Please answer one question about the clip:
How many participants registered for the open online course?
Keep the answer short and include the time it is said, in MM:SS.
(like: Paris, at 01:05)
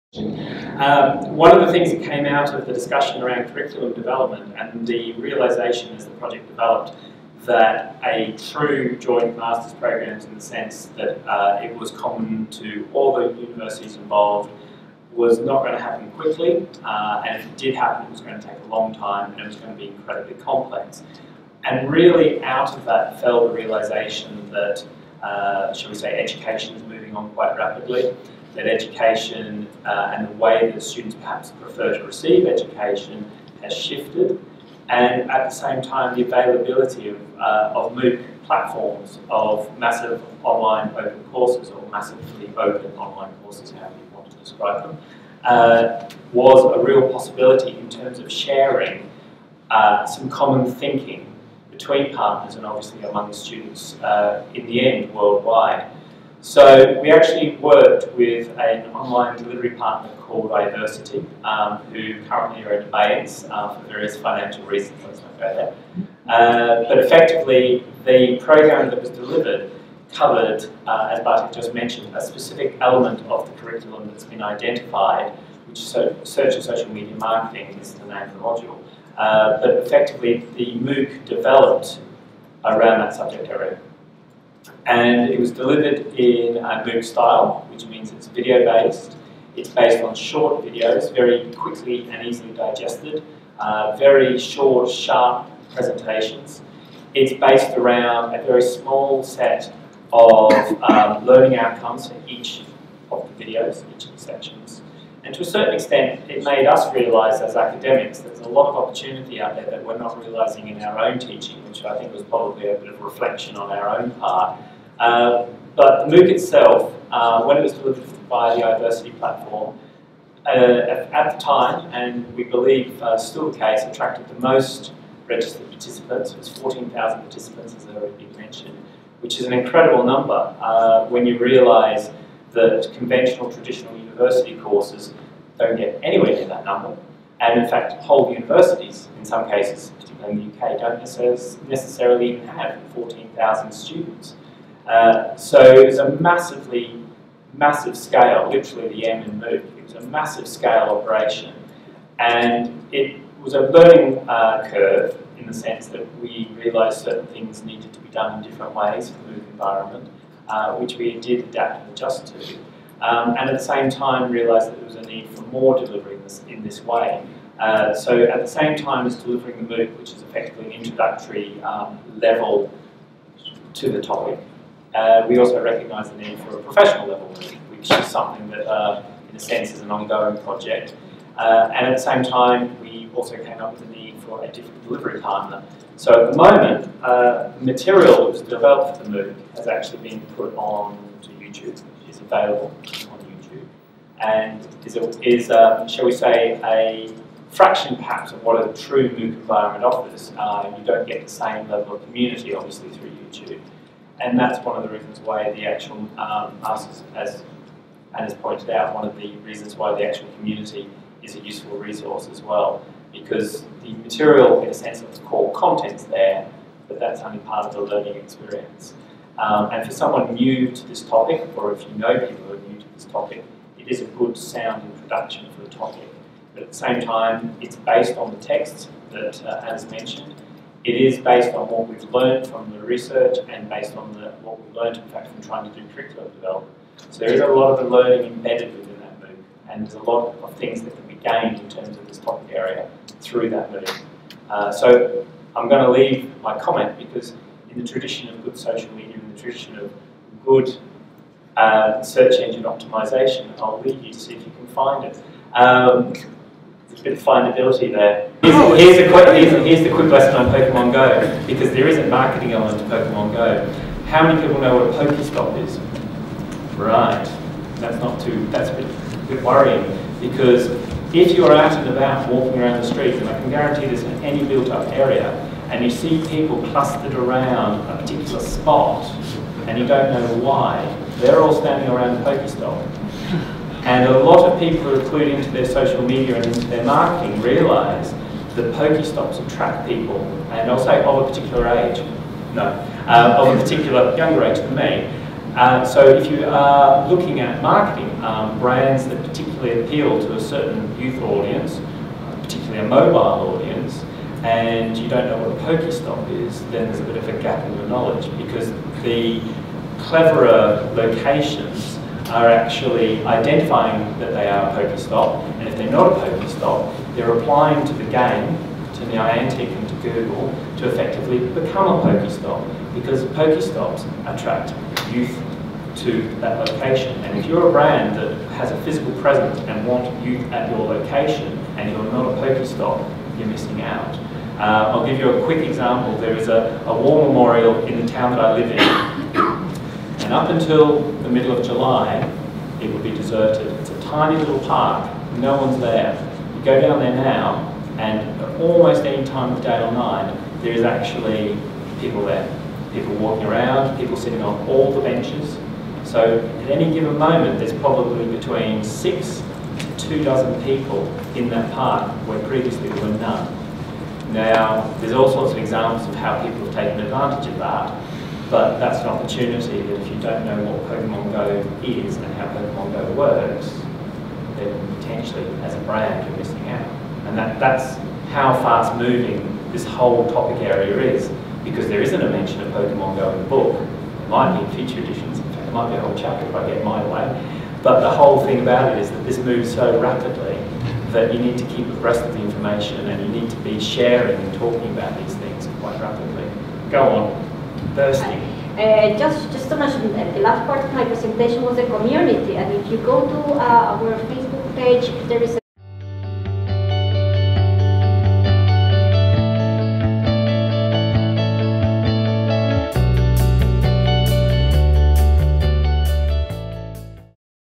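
14,000, at 02:06.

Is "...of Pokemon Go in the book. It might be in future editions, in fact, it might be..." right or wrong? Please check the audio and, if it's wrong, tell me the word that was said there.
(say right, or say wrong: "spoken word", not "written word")
right.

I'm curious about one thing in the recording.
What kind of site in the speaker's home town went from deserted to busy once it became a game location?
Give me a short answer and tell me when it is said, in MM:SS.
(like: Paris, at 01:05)
war memorial, at 05:37.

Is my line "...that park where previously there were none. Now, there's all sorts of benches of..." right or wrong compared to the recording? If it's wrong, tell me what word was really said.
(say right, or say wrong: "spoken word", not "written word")
wrong: "examples", not "benches".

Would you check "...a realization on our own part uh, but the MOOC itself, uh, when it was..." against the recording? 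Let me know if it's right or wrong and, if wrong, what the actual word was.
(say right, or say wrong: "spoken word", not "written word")
wrong: "reflection", not "realization".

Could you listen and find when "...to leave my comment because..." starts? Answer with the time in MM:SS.
04:05.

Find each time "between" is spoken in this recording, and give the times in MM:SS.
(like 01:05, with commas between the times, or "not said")
00:51, 05:58.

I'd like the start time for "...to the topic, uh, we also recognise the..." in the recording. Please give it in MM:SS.
02:53.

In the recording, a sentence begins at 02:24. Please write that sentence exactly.
Uh, so it was a massively, massive scale, literally the M in MOOC.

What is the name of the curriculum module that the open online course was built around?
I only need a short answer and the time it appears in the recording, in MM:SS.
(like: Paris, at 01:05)
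search and social media marketing, at 01:15.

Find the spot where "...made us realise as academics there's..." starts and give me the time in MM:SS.
01:46.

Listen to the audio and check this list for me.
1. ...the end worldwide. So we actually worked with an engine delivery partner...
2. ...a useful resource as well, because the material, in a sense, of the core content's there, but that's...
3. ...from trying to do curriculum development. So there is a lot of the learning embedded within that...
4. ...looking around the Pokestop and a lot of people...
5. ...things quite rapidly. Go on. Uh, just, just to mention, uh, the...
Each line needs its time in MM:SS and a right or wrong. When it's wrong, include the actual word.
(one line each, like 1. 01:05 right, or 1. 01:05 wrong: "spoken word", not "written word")
1. 00:54 wrong: "online", not "engine"
2. 03:31 right
3. 03:55 right
4. 04:41 wrong: "standing", not "looking"
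5. 06:35 right.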